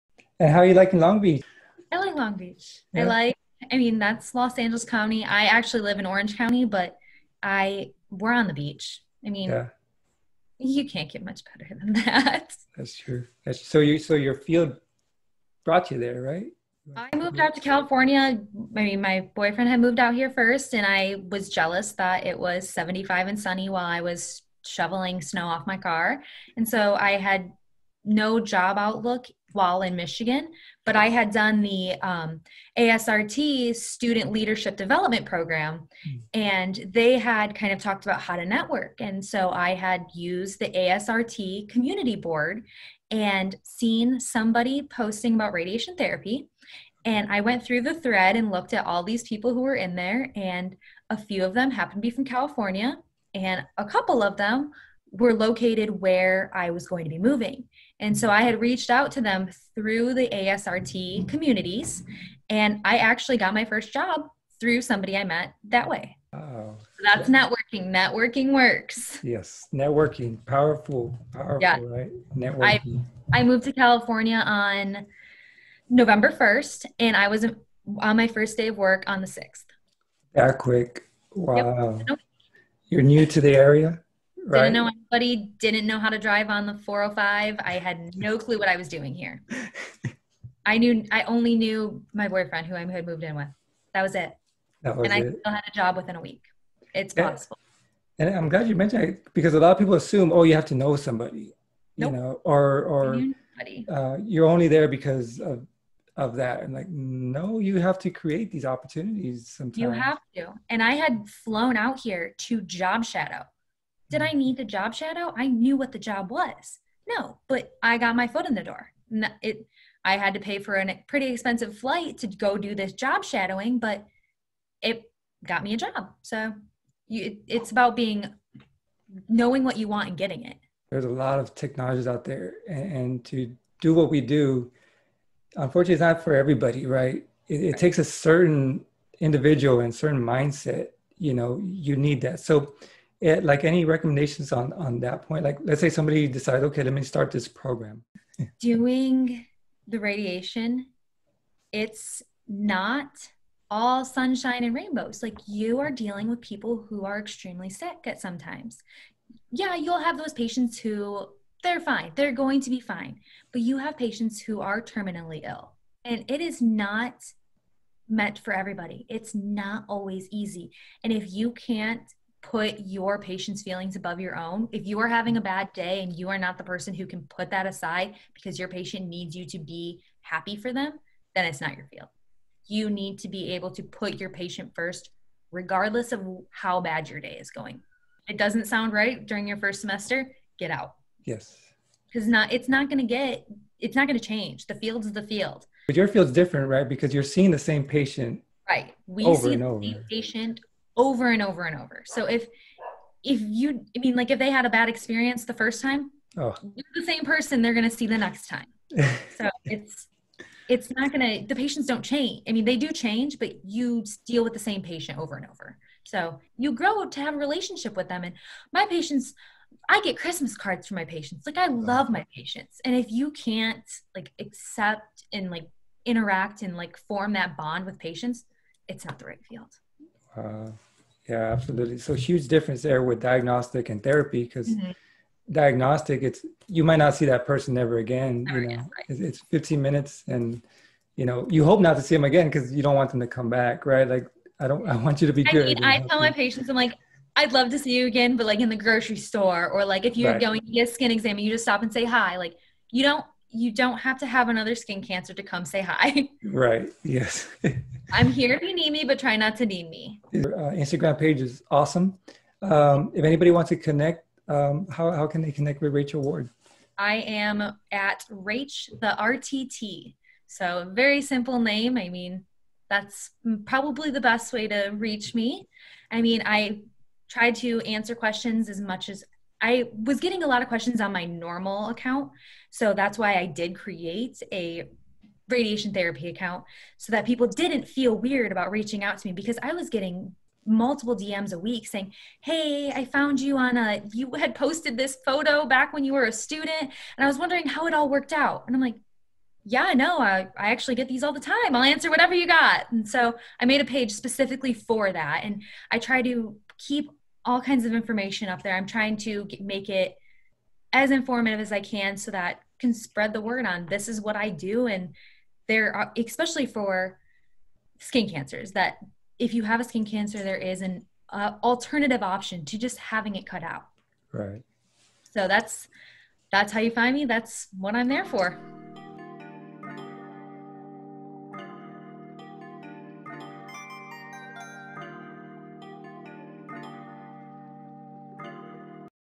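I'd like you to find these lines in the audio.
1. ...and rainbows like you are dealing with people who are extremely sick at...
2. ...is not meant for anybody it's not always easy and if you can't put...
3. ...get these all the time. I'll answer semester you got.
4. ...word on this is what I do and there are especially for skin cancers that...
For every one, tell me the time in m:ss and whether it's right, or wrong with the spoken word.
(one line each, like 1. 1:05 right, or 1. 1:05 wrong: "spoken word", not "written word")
1. 2:34 right
2. 2:46 wrong: "everybody", not "anybody"
3. 5:00 wrong: "whatever", not "semester"
4. 5:13 right.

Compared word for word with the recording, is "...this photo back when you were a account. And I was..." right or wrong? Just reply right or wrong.
wrong.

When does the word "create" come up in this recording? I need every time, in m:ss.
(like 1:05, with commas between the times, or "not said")
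1:48, 4:43.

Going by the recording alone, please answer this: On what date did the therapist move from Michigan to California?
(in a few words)
November 1st.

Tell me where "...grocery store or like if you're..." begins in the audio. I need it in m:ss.
4:08.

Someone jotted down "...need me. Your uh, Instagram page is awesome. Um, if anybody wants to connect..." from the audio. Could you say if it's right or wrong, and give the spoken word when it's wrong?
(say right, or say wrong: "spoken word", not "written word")
right.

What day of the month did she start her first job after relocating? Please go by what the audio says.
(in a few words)
6th.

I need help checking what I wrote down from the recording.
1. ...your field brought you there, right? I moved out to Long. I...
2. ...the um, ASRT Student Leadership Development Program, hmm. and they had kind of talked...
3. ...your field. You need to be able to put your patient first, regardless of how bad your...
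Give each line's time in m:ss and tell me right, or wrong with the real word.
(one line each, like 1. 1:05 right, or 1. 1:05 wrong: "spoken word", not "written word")
1. 0:14 wrong: "California", not "Long"
2. 0:31 right
3. 3:01 right.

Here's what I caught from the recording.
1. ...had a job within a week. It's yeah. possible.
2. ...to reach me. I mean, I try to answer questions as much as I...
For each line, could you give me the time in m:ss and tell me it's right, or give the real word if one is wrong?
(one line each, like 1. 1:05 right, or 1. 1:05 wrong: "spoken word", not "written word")
1. 1:35 right
2. 4:34 right.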